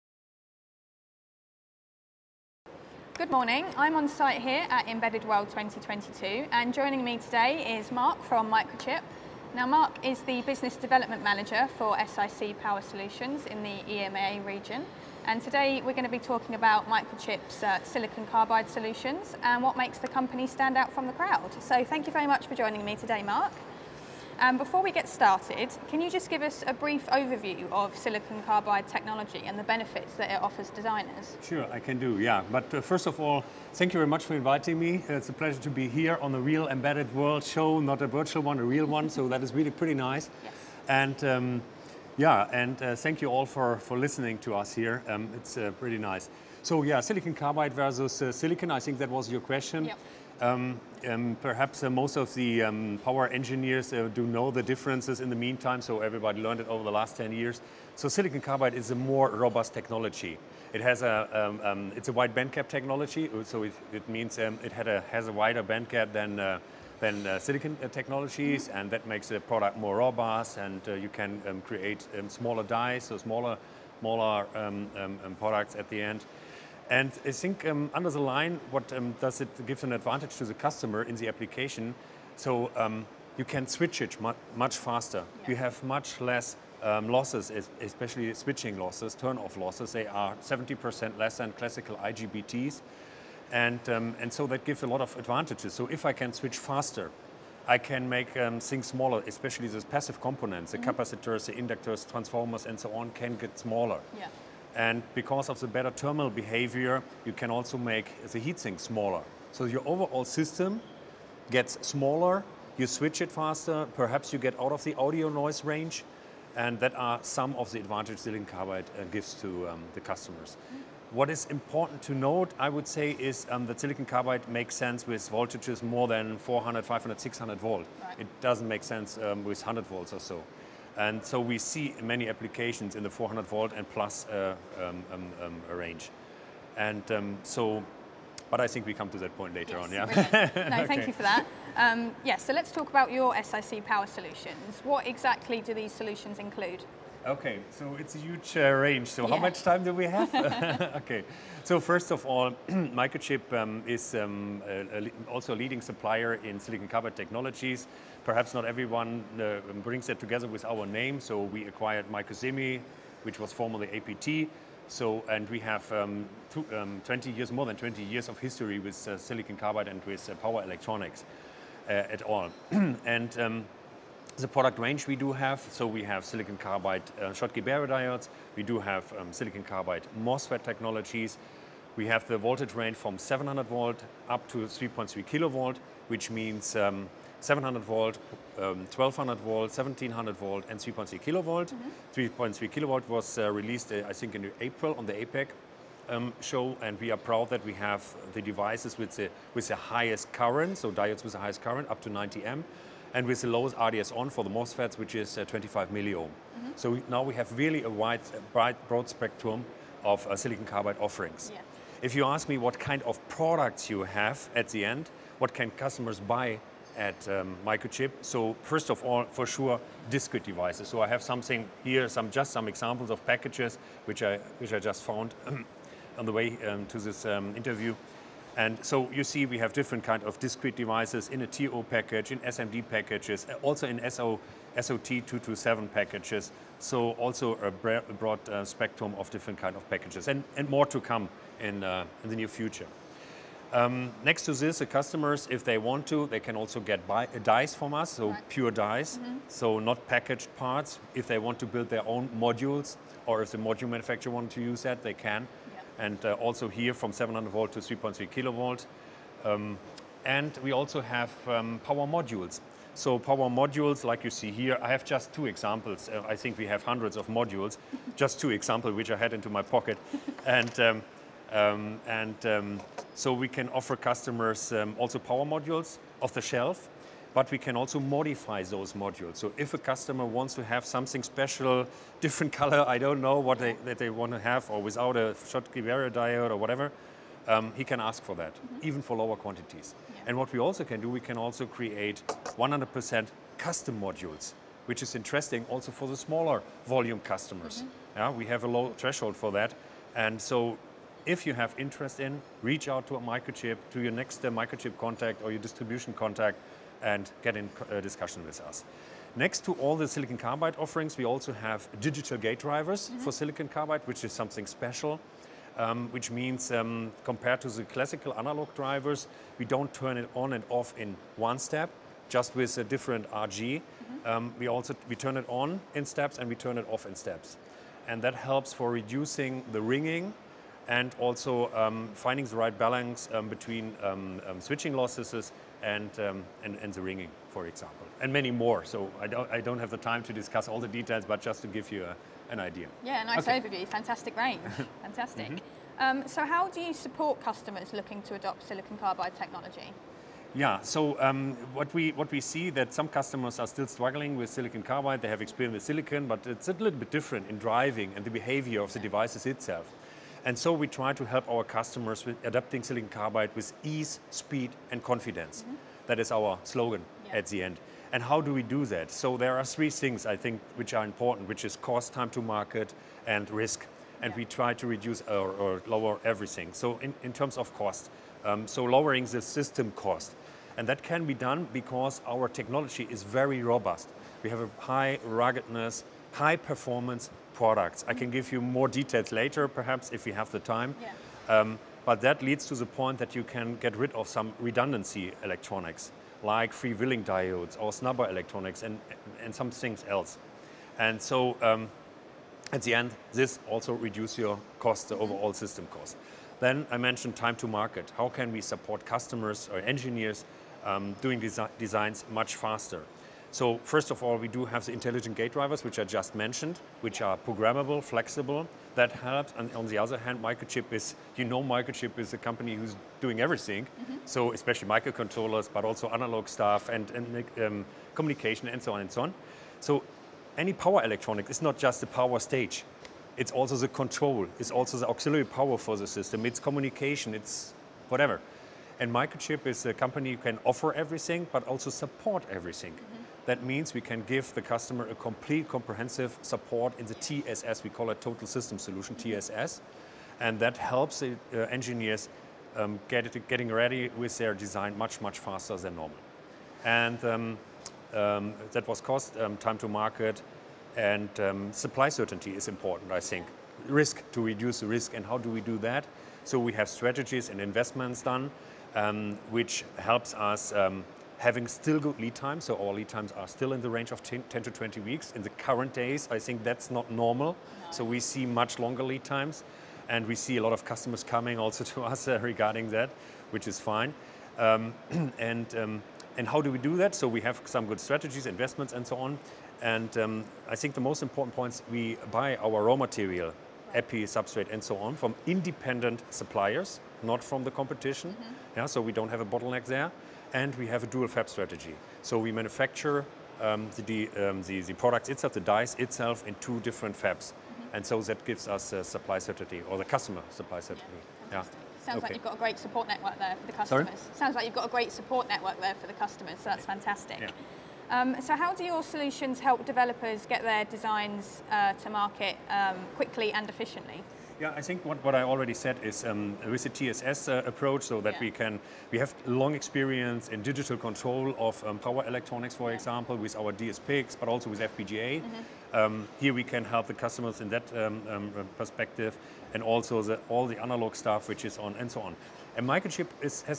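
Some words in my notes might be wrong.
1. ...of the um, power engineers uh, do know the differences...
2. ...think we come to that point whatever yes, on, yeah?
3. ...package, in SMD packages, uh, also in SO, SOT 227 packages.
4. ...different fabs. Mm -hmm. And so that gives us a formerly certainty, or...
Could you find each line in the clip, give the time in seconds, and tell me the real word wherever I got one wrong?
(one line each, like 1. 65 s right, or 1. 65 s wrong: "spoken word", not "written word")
1. 52 s right
2. 138 s wrong: "later", not "whatever"
3. 231 s right
4. 506 s wrong: "supply", not "formerly".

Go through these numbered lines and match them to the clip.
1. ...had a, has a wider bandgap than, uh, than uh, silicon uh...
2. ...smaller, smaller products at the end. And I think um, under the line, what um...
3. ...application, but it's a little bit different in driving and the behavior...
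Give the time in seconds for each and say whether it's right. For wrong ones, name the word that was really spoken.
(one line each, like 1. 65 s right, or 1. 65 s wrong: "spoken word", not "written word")
1. 64 s right
2. 73 s right
3. 355 s wrong: "silicon", not "application".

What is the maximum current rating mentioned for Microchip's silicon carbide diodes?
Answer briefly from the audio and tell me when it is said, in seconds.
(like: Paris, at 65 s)
90 amp, at 202 s.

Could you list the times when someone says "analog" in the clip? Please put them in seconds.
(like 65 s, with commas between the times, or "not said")
318 s, 426 s, 540 s.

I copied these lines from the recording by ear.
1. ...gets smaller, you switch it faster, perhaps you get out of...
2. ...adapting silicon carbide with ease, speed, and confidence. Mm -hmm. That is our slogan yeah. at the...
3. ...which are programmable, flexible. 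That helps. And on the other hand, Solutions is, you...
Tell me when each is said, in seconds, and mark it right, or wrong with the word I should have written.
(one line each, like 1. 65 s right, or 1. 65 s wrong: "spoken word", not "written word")
1. 111 s right
2. 362 s right
3. 417 s wrong: "Microchip", not "Solutions".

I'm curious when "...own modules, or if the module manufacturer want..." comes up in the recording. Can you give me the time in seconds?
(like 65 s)
252 s.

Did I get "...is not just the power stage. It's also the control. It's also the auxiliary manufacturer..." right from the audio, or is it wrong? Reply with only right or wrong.
wrong.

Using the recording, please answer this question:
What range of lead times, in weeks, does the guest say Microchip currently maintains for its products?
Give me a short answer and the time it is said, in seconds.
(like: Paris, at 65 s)
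10 to 20 weeks, at 474 s.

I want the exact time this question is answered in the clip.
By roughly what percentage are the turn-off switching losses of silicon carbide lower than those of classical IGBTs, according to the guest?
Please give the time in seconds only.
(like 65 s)
90 s.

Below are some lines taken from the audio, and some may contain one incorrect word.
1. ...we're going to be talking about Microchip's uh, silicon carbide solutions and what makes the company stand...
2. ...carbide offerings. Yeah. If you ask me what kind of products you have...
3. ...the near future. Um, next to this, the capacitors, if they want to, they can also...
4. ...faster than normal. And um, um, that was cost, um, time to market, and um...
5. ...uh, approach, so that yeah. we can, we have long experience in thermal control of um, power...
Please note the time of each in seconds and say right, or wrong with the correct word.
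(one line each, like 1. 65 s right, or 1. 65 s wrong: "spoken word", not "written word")
1. 15 s right
2. 210 s right
3. 242 s wrong: "customers", not "capacitors"
4. 455 s right
5. 527 s wrong: "digital", not "thermal".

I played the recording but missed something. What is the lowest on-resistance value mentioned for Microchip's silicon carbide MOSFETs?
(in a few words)
25 milliohm.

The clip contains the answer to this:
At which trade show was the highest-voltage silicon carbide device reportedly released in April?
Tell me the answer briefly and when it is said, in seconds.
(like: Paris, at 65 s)
APEC, at 195 s.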